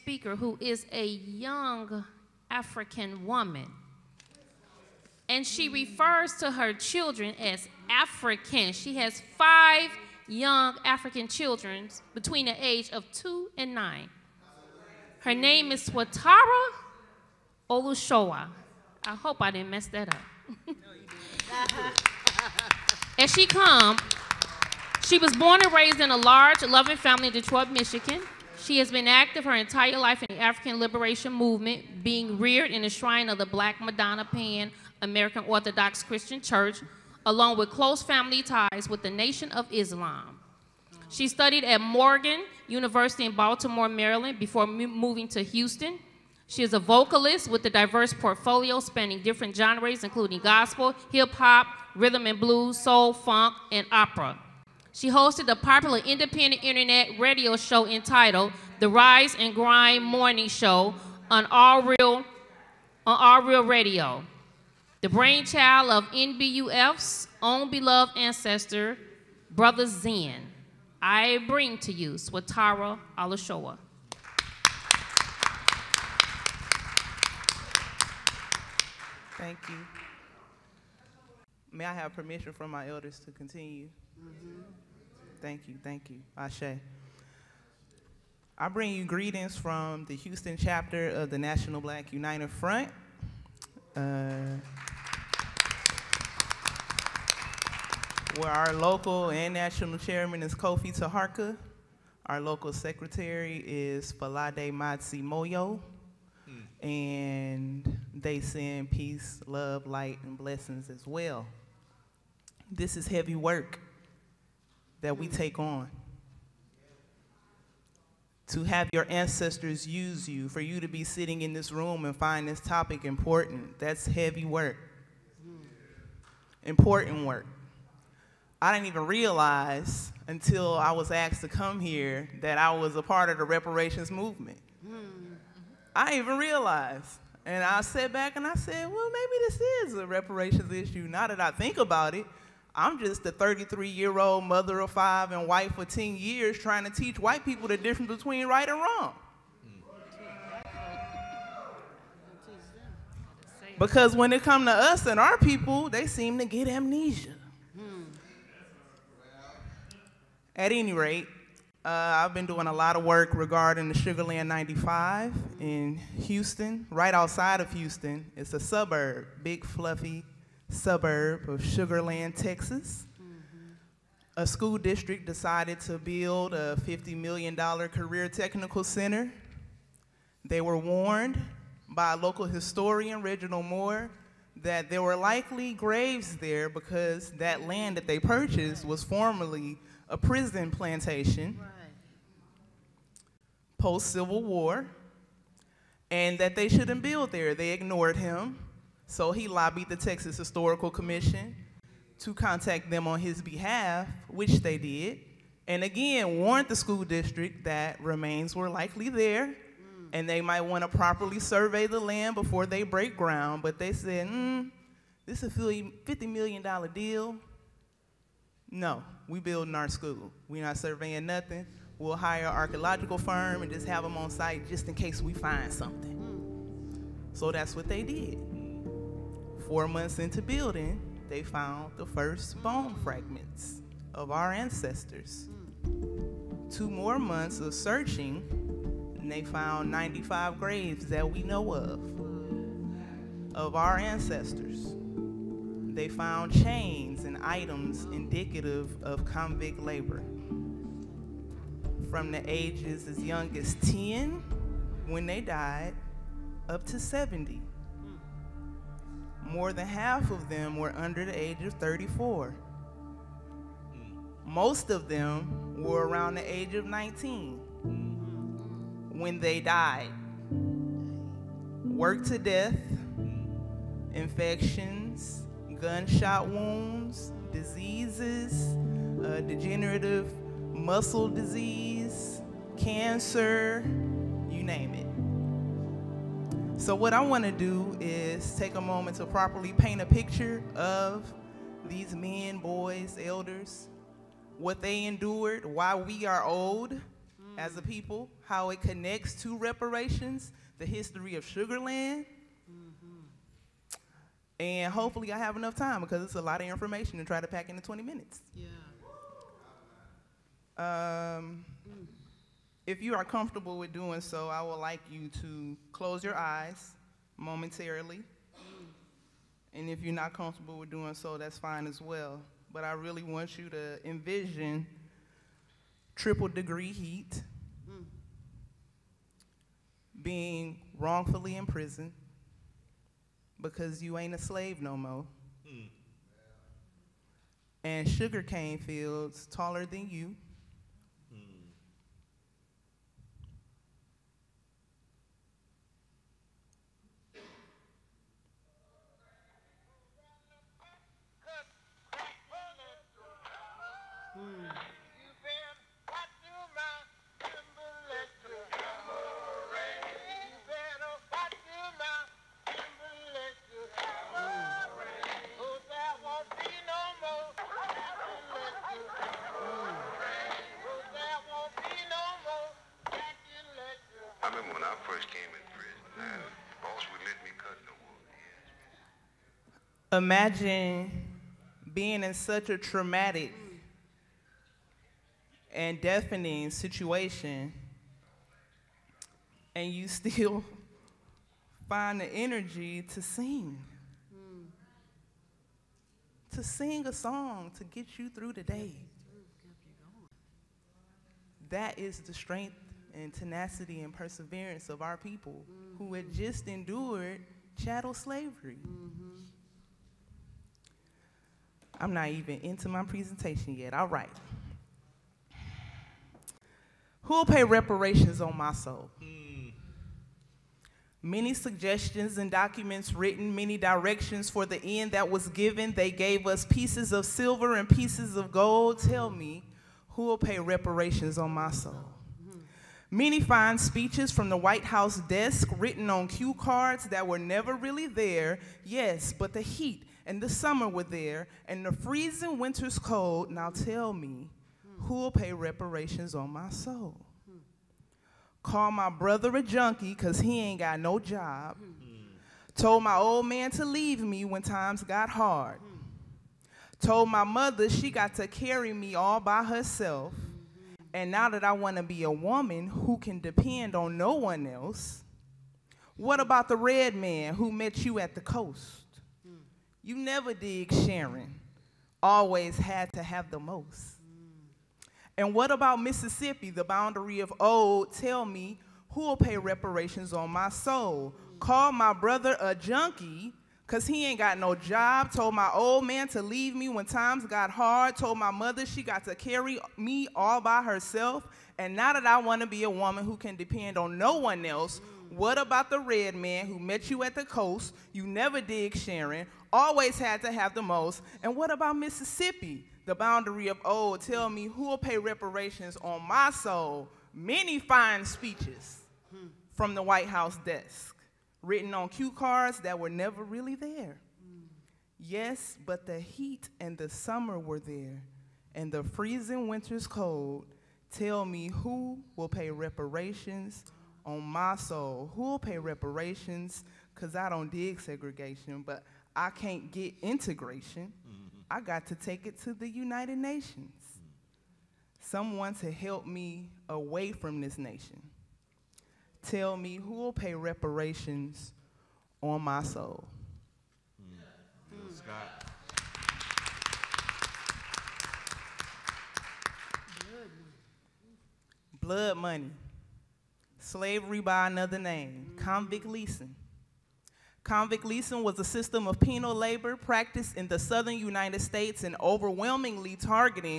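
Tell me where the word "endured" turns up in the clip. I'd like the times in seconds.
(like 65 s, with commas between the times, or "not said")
295 s, 406 s.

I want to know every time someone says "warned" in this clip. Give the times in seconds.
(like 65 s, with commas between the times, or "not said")
180 s, 206 s.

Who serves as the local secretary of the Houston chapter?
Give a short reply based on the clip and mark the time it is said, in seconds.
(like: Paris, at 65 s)
Falade Matsi Moyo, at 104 s.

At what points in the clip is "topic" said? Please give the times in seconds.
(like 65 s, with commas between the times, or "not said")
122 s.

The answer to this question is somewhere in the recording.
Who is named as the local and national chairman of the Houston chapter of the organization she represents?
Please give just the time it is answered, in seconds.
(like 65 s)
100 s.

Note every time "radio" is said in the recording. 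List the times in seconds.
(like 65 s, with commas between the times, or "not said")
57 s, 63 s.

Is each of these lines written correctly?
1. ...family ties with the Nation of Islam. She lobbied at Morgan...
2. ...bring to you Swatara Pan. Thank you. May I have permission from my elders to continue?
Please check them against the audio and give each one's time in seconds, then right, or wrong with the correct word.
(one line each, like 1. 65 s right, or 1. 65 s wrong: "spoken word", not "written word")
1. 38 s wrong: "studied", not "lobbied"
2. 71 s wrong: "Olushola", not "Pan".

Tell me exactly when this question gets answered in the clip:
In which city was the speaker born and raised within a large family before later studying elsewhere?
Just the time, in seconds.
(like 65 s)
27 s.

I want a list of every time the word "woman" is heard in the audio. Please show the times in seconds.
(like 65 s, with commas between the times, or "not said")
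3 s, 462 s, 492 s.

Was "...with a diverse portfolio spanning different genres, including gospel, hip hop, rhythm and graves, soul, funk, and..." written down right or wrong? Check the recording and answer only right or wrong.
wrong.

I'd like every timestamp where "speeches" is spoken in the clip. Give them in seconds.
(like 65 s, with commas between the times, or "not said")
433 s, 508 s.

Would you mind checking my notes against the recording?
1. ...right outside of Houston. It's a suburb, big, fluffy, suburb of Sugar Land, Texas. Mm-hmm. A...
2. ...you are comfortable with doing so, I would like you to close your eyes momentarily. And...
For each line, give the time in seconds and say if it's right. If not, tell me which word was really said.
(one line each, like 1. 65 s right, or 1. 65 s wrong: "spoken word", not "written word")
1. 166 s right
2. 313 s right.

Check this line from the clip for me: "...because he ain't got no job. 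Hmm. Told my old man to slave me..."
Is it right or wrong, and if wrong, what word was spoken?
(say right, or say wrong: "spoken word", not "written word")
wrong: "leave", not "slave".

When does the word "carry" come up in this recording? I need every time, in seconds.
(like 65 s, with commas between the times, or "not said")
458 s, 489 s.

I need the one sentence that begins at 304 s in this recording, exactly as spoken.
And hopefully I have enough time because it's a lot of information to try to pack into 20 minutes.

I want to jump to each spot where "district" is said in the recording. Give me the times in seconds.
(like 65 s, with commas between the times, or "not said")
174 s, 207 s.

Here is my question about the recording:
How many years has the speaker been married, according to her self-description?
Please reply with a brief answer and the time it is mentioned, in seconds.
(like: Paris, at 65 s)
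10 years, at 145 s.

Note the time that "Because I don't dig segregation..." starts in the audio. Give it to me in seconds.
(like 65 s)
527 s.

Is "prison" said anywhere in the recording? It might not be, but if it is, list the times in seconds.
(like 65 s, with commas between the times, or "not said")
190 s, 331 s.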